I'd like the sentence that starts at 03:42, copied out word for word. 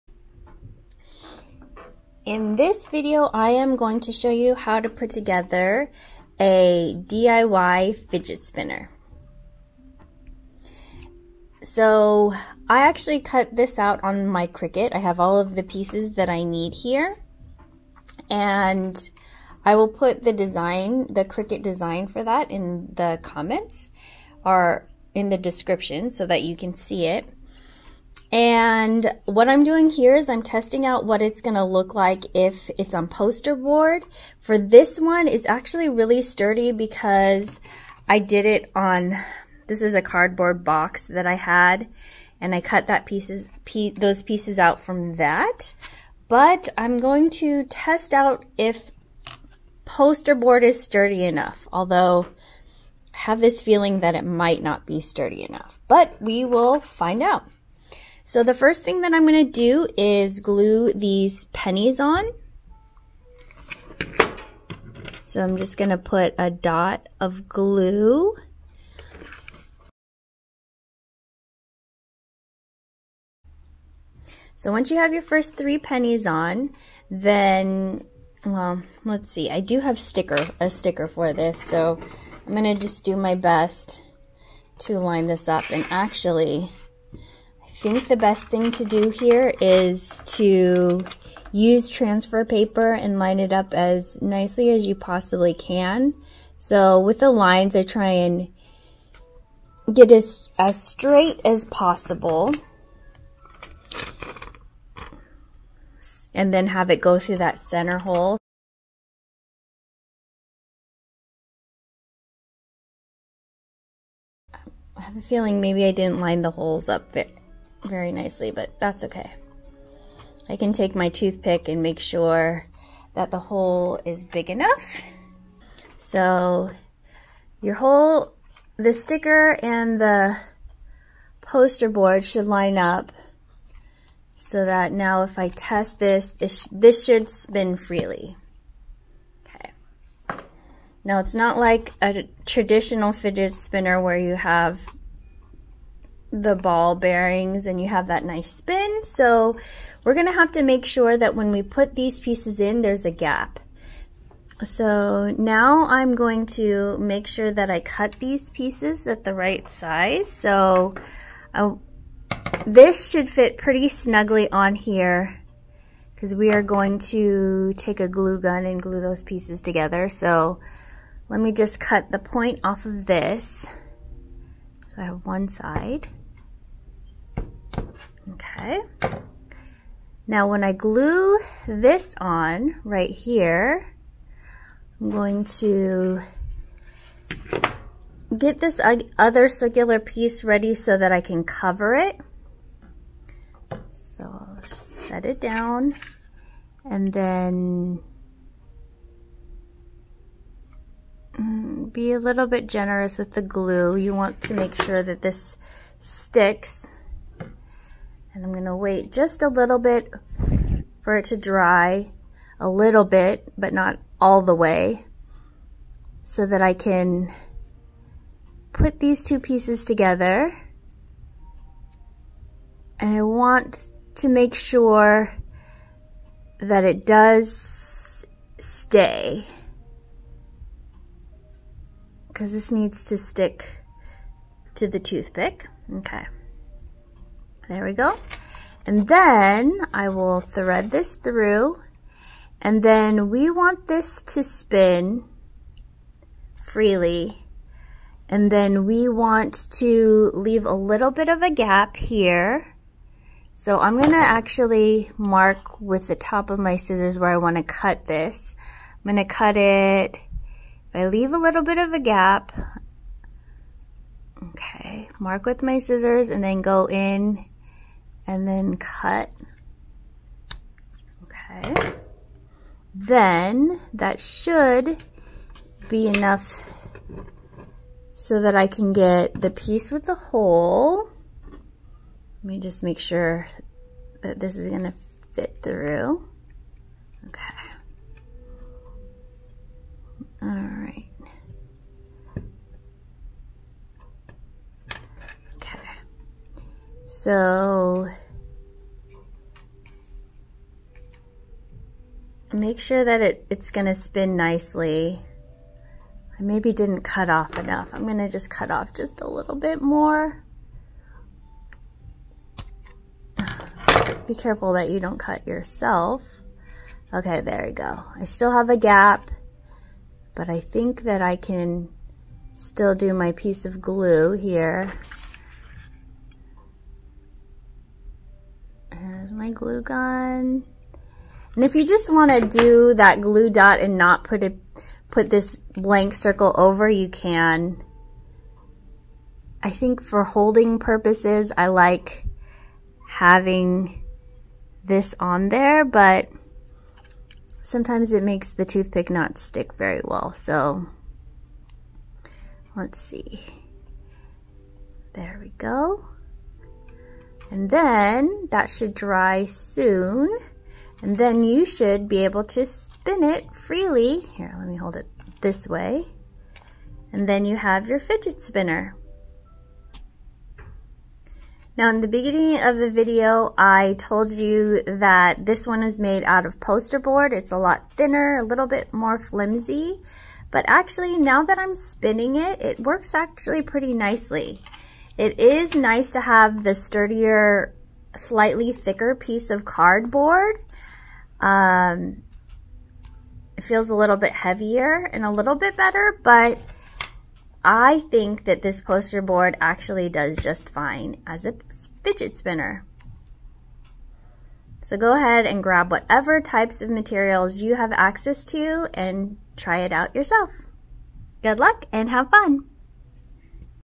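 And I want to make sure that it does stay because this needs to stick to the toothpick.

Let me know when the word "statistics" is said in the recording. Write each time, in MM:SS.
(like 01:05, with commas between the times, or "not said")
not said.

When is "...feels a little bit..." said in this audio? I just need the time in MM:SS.
06:33.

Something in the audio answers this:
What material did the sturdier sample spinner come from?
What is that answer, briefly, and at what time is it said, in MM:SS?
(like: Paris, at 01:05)
cardboard box, at 00:40.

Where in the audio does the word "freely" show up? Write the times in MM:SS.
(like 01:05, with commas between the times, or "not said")
02:17, 04:06, 06:03.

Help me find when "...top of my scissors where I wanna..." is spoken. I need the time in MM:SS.
04:16.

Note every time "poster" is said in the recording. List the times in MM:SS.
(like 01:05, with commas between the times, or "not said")
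00:33, 00:49, 02:11, 06:16, 06:38.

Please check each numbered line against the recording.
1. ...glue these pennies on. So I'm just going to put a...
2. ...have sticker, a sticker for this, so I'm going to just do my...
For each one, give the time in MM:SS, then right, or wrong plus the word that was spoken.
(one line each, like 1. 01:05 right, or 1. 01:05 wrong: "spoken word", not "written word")
1. 01:00 right
2. 01:19 right.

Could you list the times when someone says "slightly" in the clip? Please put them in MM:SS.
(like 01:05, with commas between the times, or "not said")
06:28.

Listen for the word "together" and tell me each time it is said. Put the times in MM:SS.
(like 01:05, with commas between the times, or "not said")
00:05, 02:49, 03:39.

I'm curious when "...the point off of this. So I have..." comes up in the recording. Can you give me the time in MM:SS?
02:52.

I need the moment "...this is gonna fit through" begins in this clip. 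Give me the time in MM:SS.
04:44.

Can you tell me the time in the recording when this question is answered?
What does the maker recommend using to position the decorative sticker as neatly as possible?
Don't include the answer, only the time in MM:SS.
01:31.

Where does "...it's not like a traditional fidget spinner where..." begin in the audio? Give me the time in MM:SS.
02:21.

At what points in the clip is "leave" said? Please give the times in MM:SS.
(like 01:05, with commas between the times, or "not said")
04:10, 04:21.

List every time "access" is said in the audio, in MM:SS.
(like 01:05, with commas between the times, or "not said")
06:47.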